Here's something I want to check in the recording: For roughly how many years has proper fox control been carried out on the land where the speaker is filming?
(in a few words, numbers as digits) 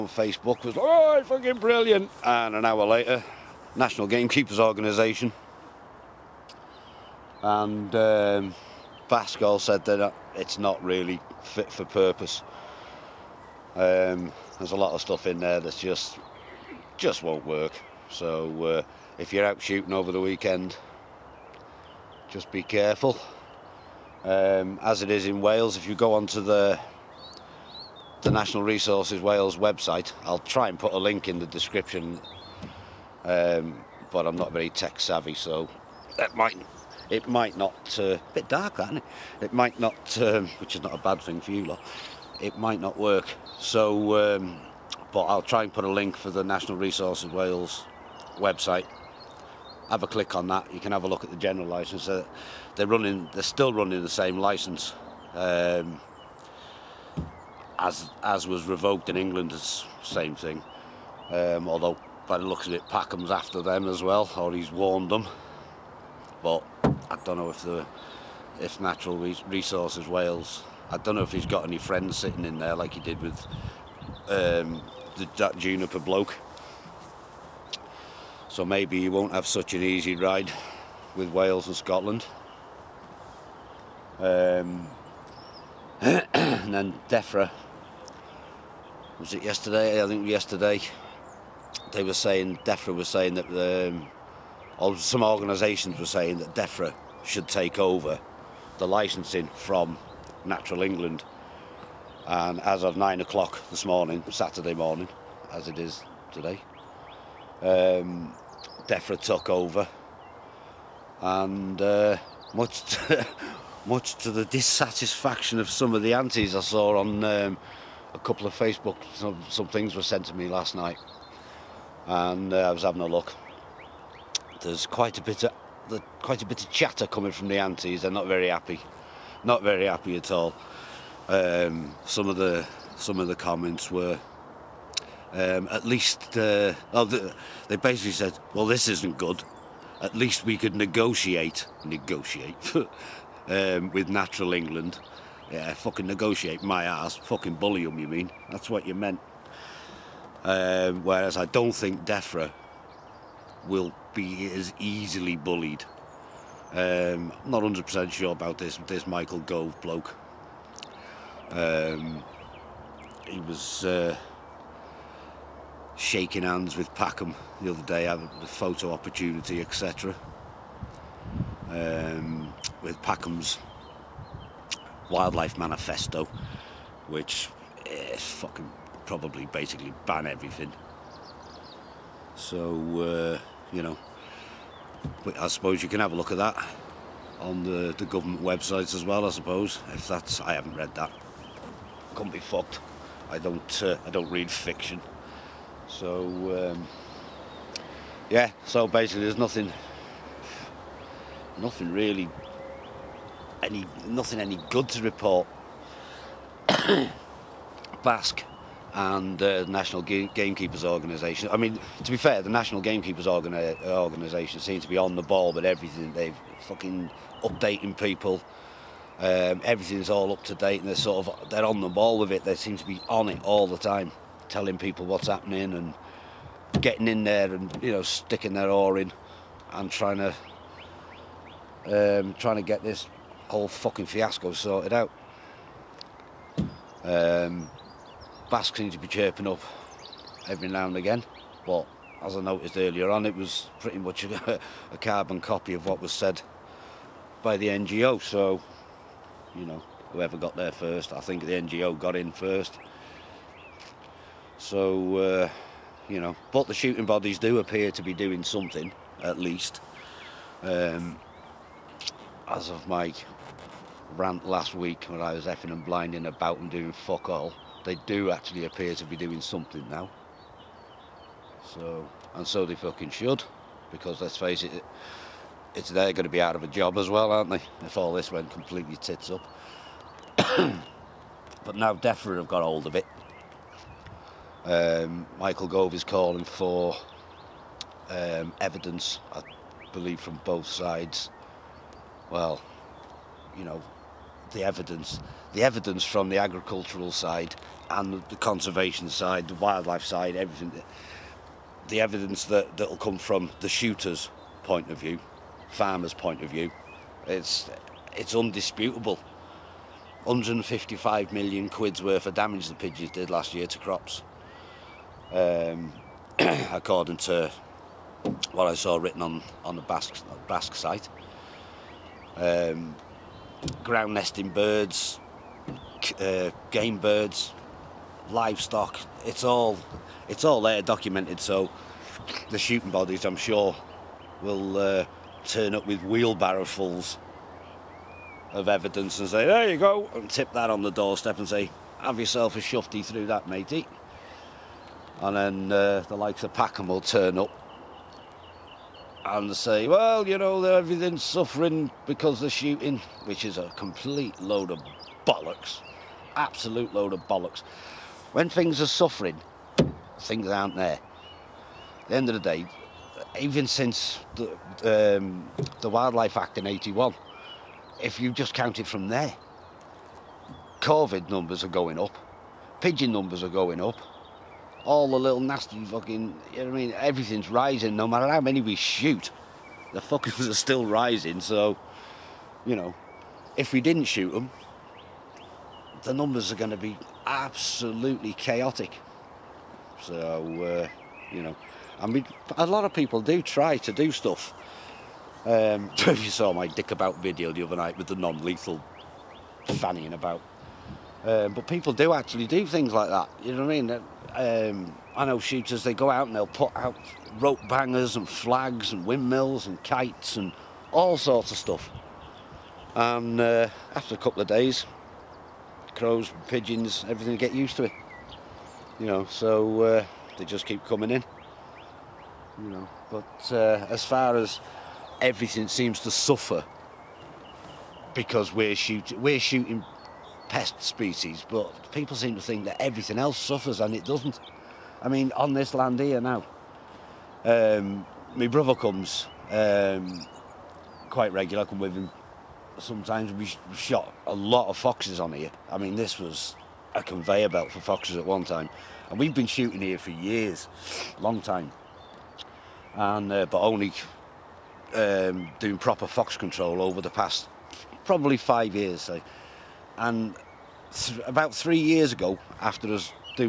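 5 years.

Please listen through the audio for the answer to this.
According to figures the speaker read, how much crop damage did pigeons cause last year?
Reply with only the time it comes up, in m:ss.
5:10.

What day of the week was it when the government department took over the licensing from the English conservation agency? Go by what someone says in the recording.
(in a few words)
Saturday.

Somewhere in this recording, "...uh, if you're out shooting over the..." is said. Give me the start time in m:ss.
0:18.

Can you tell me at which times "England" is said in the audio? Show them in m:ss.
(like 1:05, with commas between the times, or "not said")
0:59, 1:40, 2:24.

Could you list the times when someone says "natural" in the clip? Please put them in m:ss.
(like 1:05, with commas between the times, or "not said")
1:08, 1:40, 2:24.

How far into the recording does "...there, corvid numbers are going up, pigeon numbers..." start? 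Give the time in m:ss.
6:09.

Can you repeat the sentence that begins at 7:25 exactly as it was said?
I mean, this was a conveyor belt for foxes at one time.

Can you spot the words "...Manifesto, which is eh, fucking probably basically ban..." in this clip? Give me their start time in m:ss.
2:55.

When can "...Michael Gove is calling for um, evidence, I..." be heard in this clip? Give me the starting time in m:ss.
4:45.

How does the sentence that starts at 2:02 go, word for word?
And uh, I was having a look there's quite a bit of quite a bit of chatter coming from the antis.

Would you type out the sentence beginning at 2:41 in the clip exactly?
Um, he was uh, shaking hands with Packham the other day, having a photo opportunity, etc.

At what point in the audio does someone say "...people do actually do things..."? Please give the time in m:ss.
6:41.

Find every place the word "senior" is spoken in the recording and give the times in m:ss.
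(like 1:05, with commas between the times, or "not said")
not said.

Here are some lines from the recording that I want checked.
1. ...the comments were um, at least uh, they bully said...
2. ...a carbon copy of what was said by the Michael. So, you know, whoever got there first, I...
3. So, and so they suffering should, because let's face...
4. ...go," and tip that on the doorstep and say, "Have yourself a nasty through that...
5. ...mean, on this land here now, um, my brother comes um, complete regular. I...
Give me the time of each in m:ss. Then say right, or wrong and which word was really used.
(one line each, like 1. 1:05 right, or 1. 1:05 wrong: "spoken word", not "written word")
1. 2:13 wrong: "basically", not "bully"
2. 4:04 wrong: "NGO", not "Michael"
3. 4:31 wrong: "fucking", not "suffering"
4. 5:39 wrong: "shufty", not "nasty"
5. 7:15 wrong: "quite", not "complete".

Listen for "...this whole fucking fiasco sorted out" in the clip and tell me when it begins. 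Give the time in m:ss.
3:52.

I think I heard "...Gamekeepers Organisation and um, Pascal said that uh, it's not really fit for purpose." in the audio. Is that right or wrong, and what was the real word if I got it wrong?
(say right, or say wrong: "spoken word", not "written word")
right.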